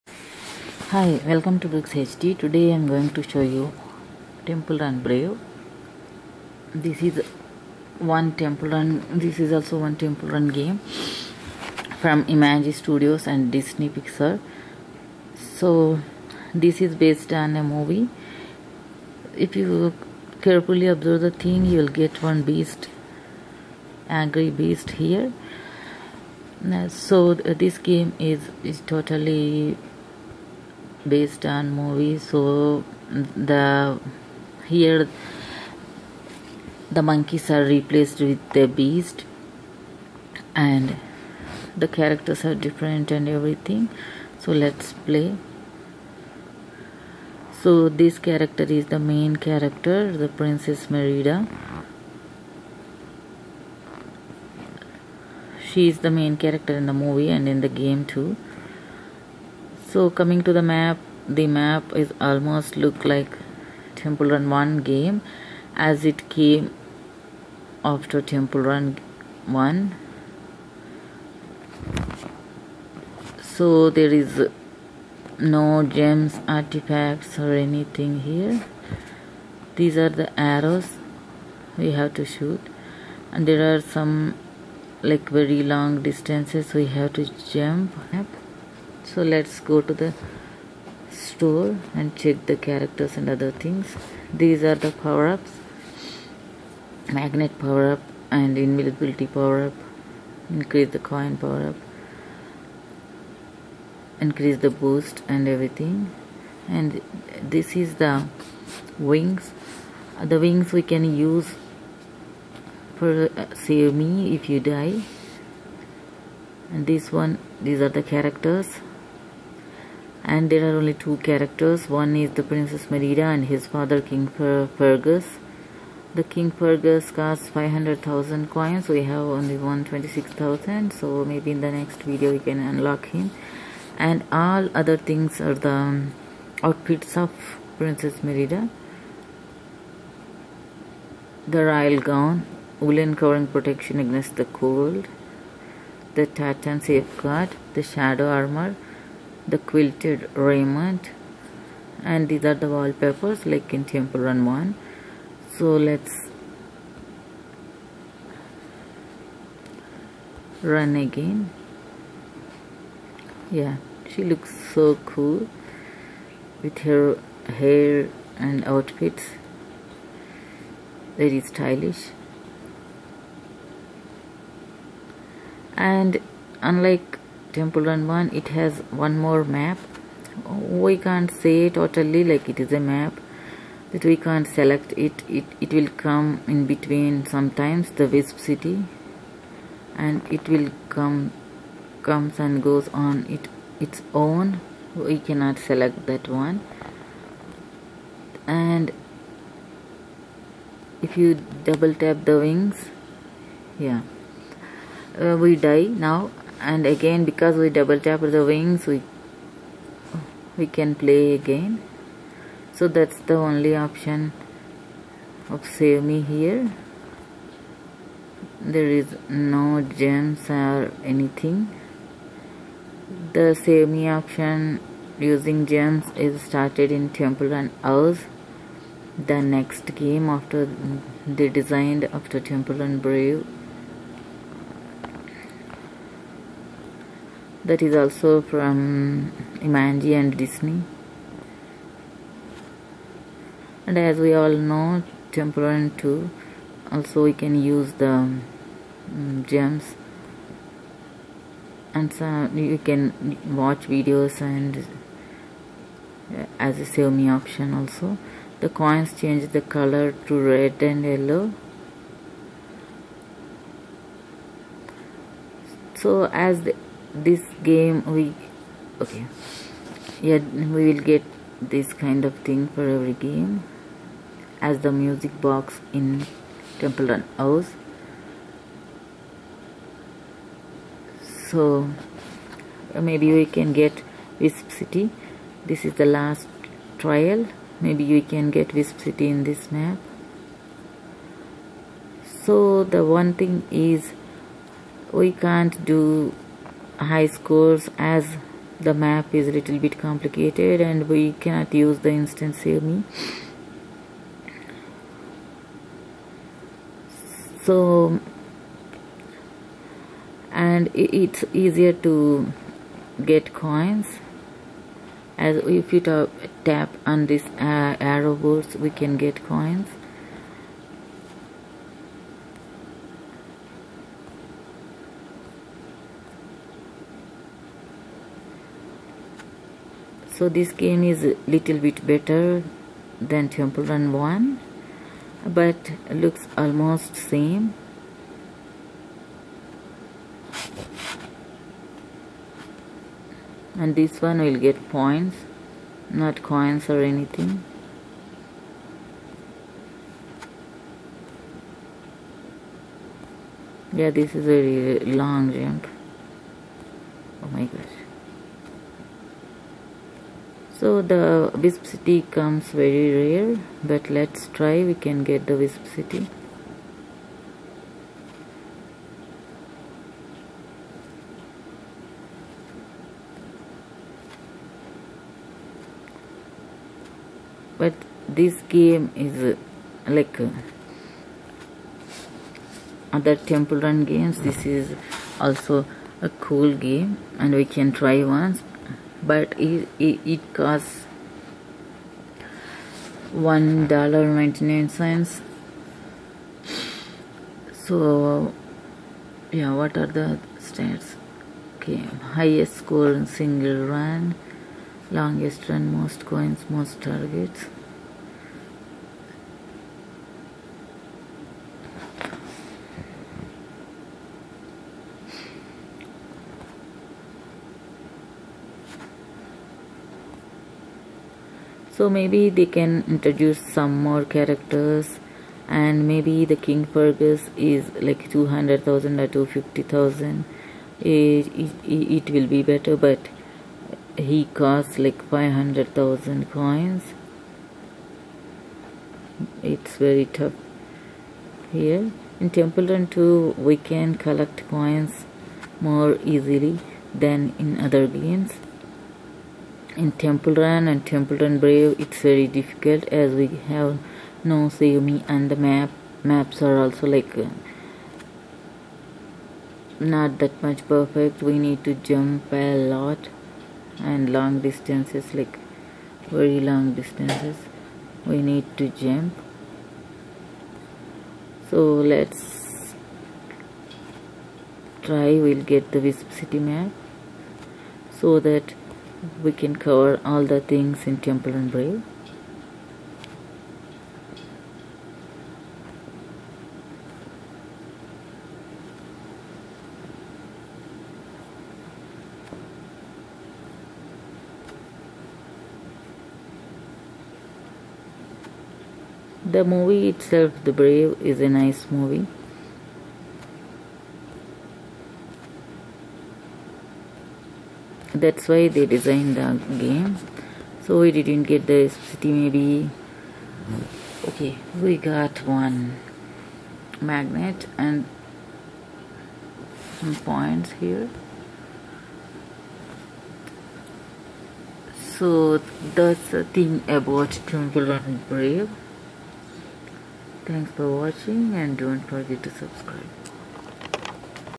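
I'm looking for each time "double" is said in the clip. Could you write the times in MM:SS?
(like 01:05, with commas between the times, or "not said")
03:21, 03:27.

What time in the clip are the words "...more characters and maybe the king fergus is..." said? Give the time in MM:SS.
07:04.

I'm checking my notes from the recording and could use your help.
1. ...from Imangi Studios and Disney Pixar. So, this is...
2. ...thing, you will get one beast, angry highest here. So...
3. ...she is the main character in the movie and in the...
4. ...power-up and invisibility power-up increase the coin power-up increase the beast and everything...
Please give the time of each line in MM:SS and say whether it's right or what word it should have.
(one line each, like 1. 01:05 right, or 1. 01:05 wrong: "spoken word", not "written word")
1. 00:12 right
2. 00:21 wrong: "beast", not "highest"
3. 00:55 right
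4. 01:37 wrong: "boost", not "beast".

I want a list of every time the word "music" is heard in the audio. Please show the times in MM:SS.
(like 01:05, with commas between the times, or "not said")
04:34.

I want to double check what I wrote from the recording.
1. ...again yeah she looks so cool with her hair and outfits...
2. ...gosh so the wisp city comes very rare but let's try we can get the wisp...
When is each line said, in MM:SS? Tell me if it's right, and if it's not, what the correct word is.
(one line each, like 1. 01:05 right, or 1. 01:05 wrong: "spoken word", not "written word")
1. 02:40 right
2. 05:57 right.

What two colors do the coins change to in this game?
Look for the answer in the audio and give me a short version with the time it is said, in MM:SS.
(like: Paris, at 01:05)
red and yellow, at 04:20.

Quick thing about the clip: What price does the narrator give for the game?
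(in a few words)
$1.99.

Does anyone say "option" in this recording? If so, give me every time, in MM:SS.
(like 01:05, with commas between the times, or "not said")
03:33, 03:44, 04:17.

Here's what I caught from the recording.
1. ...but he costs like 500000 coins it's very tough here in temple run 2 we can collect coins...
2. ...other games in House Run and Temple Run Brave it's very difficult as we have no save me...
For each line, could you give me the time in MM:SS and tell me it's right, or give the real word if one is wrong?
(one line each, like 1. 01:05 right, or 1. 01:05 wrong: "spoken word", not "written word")
1. 07:12 right
2. 07:27 wrong: "Temple", not "House".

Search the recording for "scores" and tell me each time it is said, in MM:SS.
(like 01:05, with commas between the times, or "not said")
04:57, 06:42.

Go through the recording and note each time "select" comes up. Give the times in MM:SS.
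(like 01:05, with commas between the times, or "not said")
03:04, 03:15.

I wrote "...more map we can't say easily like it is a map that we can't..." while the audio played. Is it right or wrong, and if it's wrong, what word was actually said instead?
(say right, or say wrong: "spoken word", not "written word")
wrong: "totally", not "easily".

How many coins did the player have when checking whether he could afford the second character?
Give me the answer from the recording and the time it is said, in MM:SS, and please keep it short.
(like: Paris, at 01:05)
126000, at 02:09.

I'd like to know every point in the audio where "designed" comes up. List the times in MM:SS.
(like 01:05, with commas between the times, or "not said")
03:51, 08:28.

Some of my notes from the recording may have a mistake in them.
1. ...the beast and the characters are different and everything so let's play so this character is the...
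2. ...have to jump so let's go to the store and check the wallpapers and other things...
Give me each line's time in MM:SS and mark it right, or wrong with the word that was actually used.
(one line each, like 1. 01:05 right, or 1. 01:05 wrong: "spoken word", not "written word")
1. 00:38 right
2. 01:26 wrong: "characters", not "wallpapers".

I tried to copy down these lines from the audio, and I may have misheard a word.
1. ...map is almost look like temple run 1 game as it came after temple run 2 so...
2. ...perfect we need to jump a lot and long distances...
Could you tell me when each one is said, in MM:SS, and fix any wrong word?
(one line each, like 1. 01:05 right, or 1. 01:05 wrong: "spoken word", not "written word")
1. 01:01 wrong: "1", not "2"
2. 07:40 right.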